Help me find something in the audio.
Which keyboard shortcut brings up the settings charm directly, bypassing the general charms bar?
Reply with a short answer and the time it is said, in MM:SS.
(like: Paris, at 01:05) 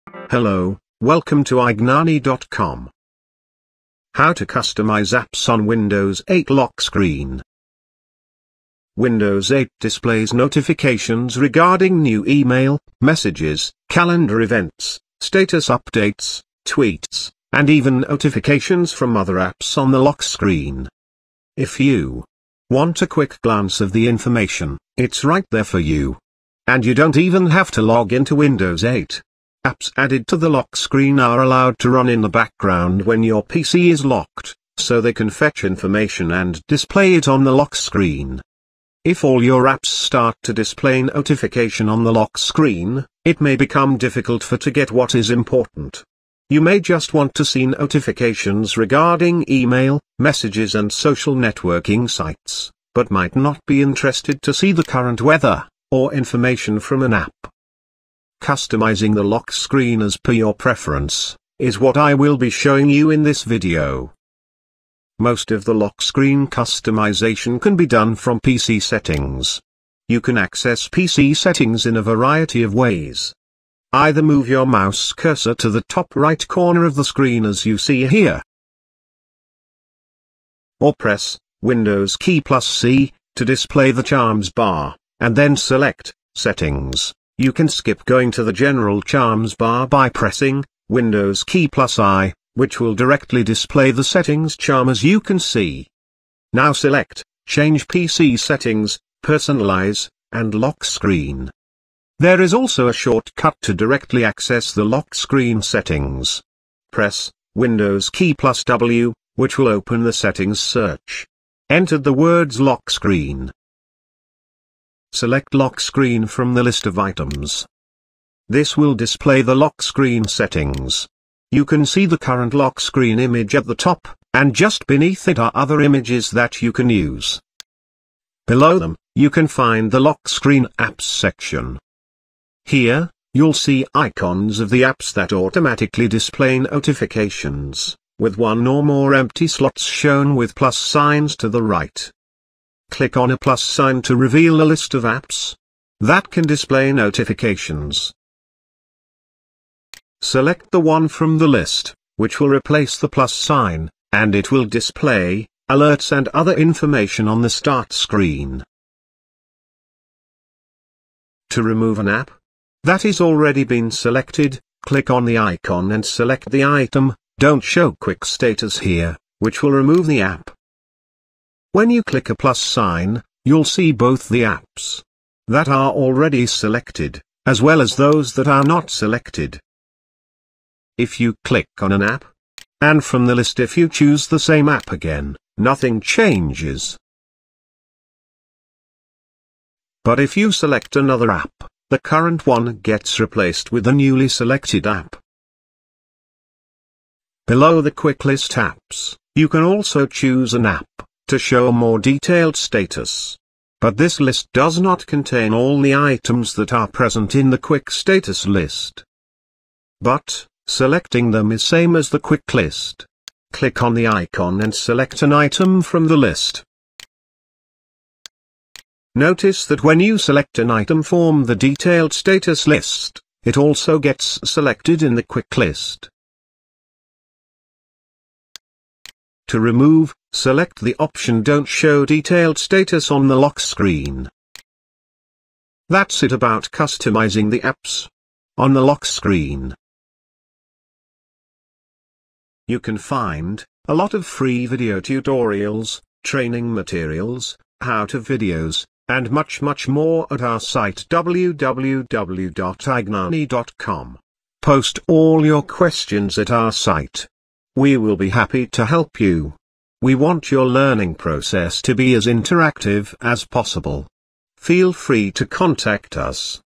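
Windows key plus I, at 01:30.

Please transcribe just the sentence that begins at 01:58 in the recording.
This will display the lock screen settings.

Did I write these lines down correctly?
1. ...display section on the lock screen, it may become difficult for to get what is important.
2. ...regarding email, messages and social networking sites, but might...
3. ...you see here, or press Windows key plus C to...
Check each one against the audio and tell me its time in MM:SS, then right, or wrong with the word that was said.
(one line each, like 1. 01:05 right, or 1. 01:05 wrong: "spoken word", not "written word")
1. 00:40 wrong: "notification", not "section"
2. 00:48 right
3. 01:17 right.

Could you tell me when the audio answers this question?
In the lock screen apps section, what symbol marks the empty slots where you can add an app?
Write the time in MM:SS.
02:20.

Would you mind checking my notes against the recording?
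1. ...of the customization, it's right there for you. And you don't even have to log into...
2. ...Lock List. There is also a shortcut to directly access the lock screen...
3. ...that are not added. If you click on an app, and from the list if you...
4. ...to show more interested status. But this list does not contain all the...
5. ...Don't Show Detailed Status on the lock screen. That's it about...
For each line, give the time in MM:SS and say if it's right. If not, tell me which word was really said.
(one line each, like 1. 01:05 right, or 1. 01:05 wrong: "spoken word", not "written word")
1. 00:23 wrong: "information", not "customization"
2. 01:40 wrong: "Screen", not "List"
3. 02:58 wrong: "selected", not "added"
4. 03:21 wrong: "detailed", not "interested"
5. 03:51 right.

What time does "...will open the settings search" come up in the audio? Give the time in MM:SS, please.
01:49.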